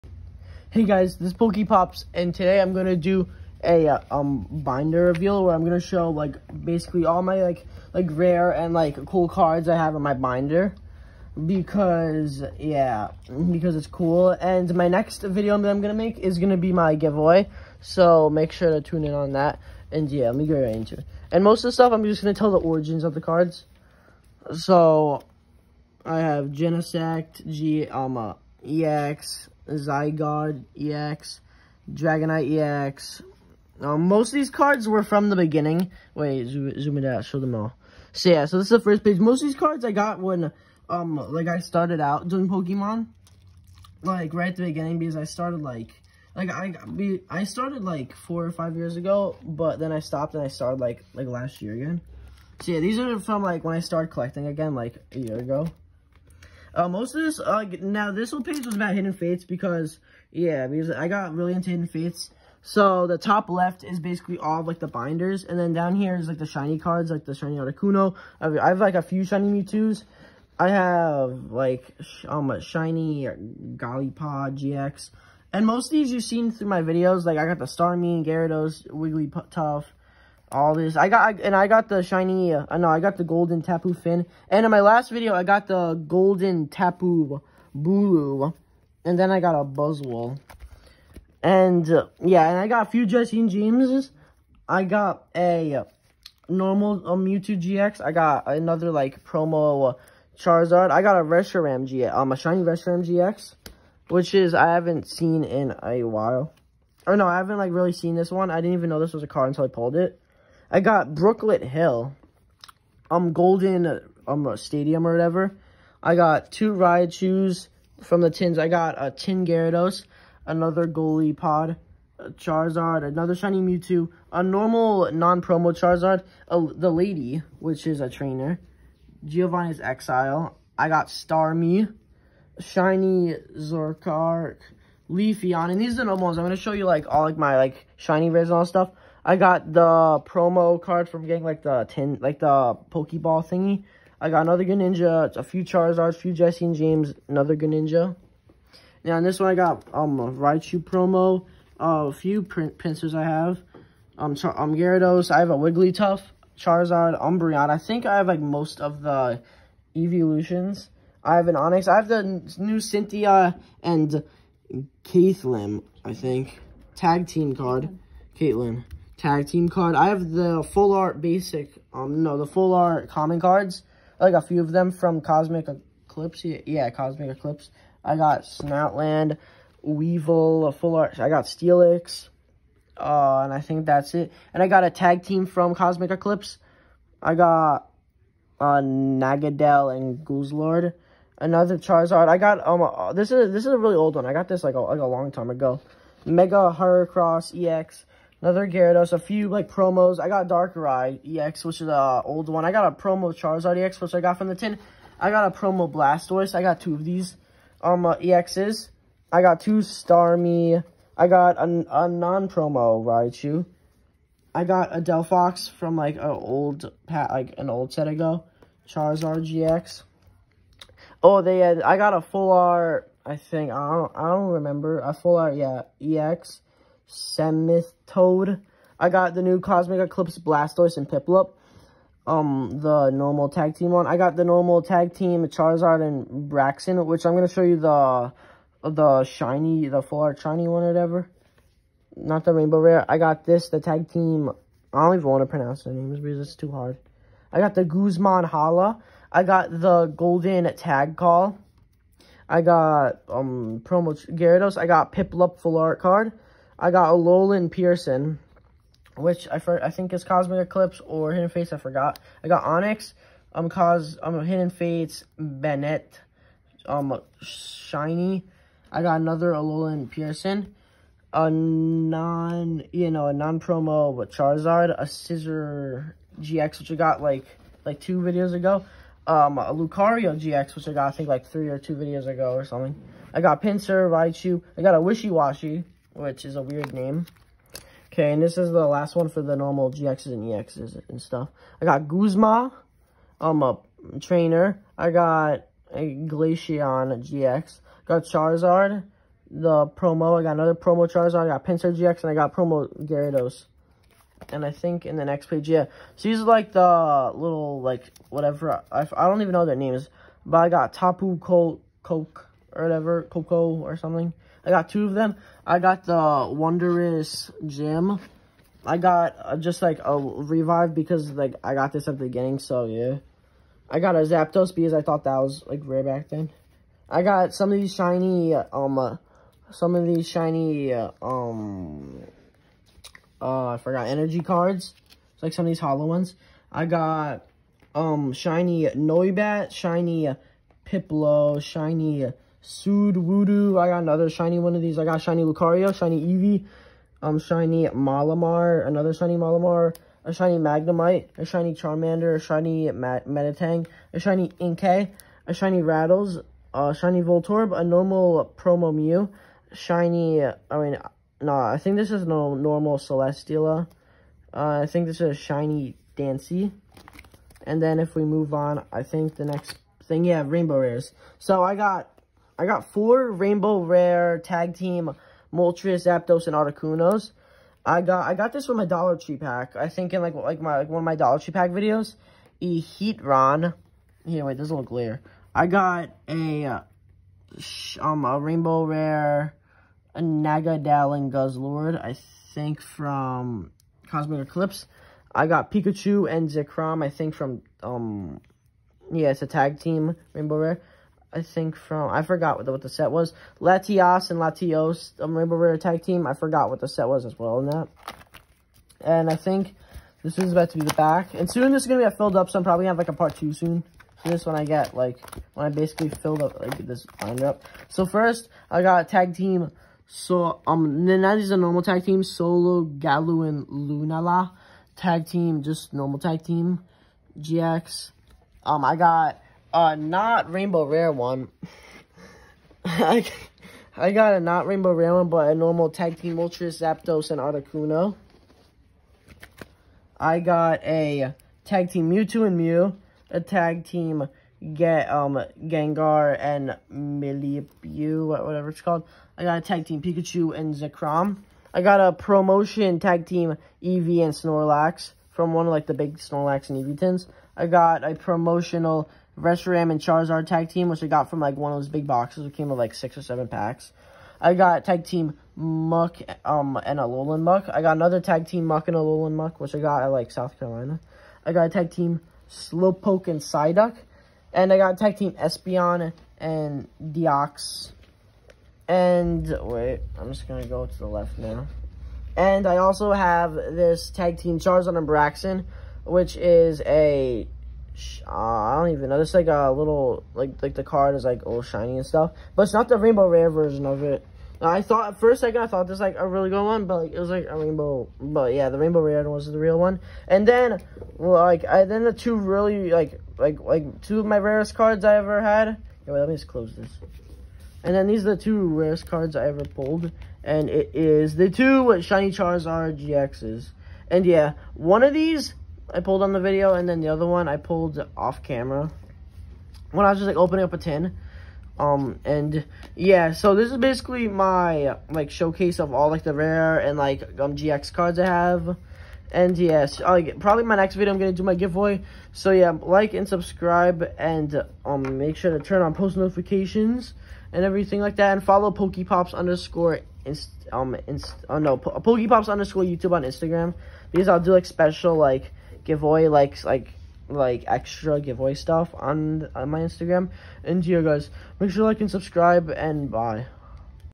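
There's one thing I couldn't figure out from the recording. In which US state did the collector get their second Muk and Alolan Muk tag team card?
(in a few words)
South Carolina.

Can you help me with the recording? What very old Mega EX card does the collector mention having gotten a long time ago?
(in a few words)
Mega Heracross EX.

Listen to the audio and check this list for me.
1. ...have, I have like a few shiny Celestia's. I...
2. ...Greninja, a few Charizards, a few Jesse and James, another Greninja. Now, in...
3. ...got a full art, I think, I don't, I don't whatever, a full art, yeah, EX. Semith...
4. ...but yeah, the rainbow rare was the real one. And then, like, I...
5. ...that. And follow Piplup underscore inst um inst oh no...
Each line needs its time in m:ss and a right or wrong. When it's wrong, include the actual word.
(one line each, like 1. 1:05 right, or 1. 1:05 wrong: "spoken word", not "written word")
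1. 1:08 wrong: "Mewtwo", not "Celestia"
2. 2:24 right
3. 3:41 wrong: "remember", not "whatever"
4. 8:18 right
5. 8:58 wrong: "Pokepops", not "Piplup".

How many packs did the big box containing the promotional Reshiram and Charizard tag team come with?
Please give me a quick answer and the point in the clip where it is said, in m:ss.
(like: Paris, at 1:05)
6 or 7, at 7:42.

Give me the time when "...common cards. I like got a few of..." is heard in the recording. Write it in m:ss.
2:53.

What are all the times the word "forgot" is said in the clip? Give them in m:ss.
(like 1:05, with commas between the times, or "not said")
4:21, 5:33, 6:42, 6:46.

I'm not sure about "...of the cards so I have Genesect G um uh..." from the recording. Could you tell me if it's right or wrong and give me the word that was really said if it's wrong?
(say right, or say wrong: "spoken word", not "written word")
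right.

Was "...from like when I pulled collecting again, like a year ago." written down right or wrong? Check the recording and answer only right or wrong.
wrong.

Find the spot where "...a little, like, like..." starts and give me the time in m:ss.
8:09.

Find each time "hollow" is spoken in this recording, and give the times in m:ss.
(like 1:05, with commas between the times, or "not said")
5:35.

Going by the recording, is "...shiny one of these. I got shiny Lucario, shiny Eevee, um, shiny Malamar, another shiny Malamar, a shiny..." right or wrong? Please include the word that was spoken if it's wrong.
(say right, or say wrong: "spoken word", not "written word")
right.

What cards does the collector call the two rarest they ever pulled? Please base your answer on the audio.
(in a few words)
Shiny Charizard GXs.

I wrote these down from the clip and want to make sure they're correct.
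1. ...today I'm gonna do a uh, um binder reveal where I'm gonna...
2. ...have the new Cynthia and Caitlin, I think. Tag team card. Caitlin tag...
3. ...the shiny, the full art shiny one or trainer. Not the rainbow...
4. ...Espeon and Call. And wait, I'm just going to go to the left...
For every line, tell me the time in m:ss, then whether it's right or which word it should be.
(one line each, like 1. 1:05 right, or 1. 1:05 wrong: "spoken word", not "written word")
1. 0:02 right
2. 2:41 right
3. 3:58 wrong: "whatever", not "trainer"
4. 7:55 wrong: "Deox", not "Call".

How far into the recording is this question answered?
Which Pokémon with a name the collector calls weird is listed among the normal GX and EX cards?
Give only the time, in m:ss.
4:44.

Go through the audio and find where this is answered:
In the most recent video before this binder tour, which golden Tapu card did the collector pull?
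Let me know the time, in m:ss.
1:25.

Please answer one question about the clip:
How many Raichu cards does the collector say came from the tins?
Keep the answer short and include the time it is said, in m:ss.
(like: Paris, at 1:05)
2, at 1:56.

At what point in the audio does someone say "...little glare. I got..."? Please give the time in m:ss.
6:24.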